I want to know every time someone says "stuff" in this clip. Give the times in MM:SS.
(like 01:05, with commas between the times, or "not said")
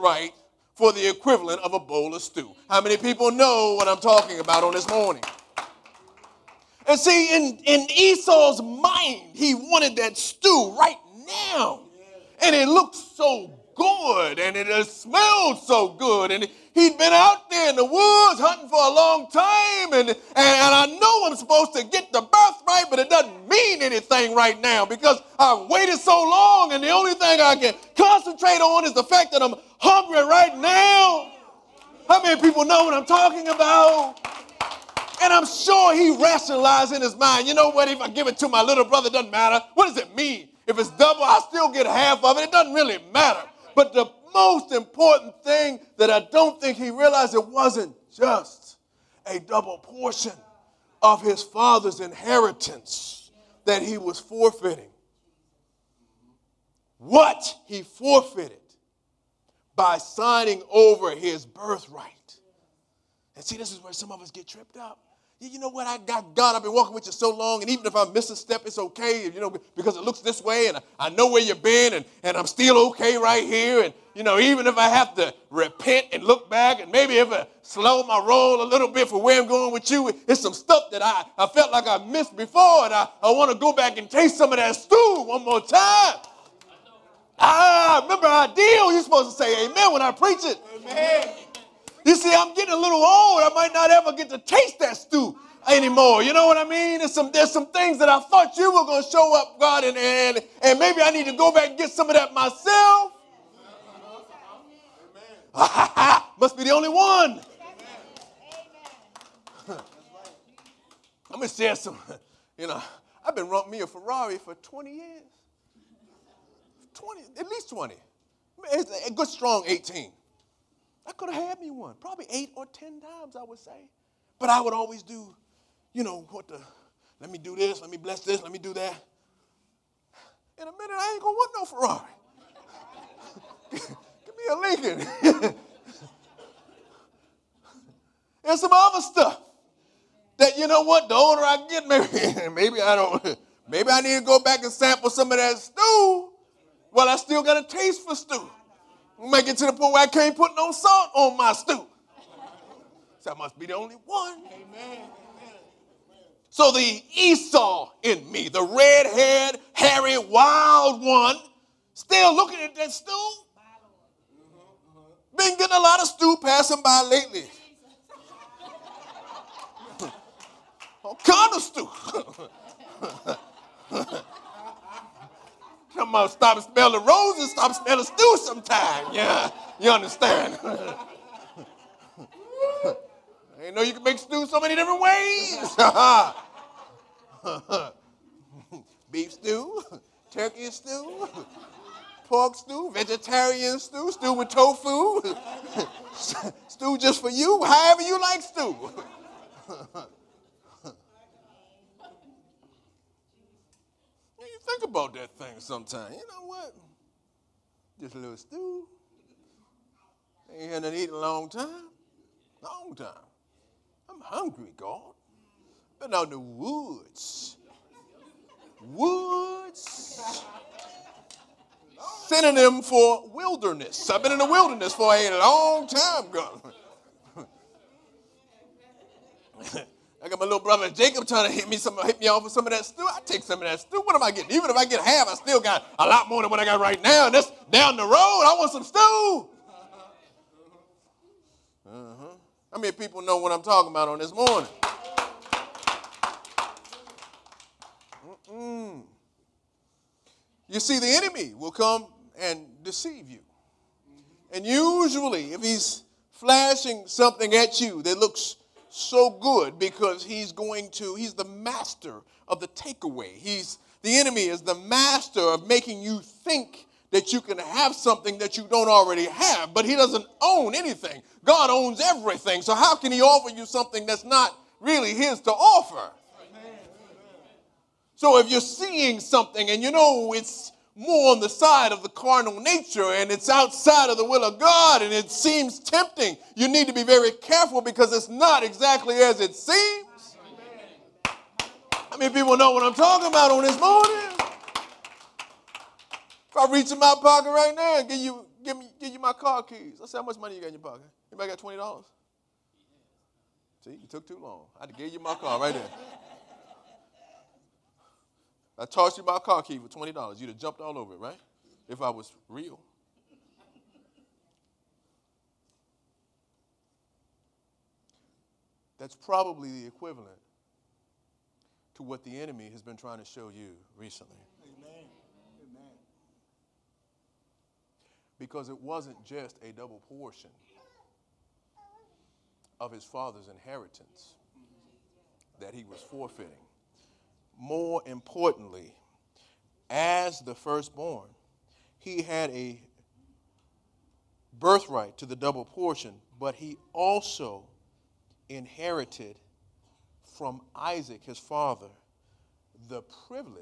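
01:20, 02:19.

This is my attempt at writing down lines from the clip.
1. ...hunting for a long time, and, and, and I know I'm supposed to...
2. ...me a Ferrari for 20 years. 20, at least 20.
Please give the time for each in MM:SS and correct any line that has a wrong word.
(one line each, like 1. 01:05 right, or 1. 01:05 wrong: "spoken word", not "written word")
1. 00:18 right
2. 01:53 right.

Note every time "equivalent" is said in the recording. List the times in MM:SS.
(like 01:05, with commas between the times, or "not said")
00:01, 05:19.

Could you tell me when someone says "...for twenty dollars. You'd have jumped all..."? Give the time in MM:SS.
05:09.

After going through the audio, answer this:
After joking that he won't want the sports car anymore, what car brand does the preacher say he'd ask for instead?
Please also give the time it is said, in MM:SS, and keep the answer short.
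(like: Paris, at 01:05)
Lincoln, at 02:14.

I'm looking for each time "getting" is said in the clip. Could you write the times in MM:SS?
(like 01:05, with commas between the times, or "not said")
01:32, 02:45, 03:54.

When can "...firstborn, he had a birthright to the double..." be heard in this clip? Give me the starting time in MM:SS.
05:40.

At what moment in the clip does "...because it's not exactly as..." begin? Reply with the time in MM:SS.
04:47.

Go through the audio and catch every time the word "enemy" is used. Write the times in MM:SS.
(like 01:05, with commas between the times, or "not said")
04:11, 04:24, 05:22.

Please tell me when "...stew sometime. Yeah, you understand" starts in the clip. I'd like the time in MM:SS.
02:58.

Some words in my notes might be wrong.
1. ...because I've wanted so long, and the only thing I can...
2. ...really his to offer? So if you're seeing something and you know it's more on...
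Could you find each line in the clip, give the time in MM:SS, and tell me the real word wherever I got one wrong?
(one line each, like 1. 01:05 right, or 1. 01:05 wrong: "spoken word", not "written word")
1. 00:24 wrong: "waited", not "wanted"
2. 04:34 right.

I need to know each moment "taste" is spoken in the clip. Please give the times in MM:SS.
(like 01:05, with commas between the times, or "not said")
01:24, 01:34, 02:27.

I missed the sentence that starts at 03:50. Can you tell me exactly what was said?
little brother Jacob trying to hit me some hit me off with some of that stew.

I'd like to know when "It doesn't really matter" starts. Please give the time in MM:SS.
00:42.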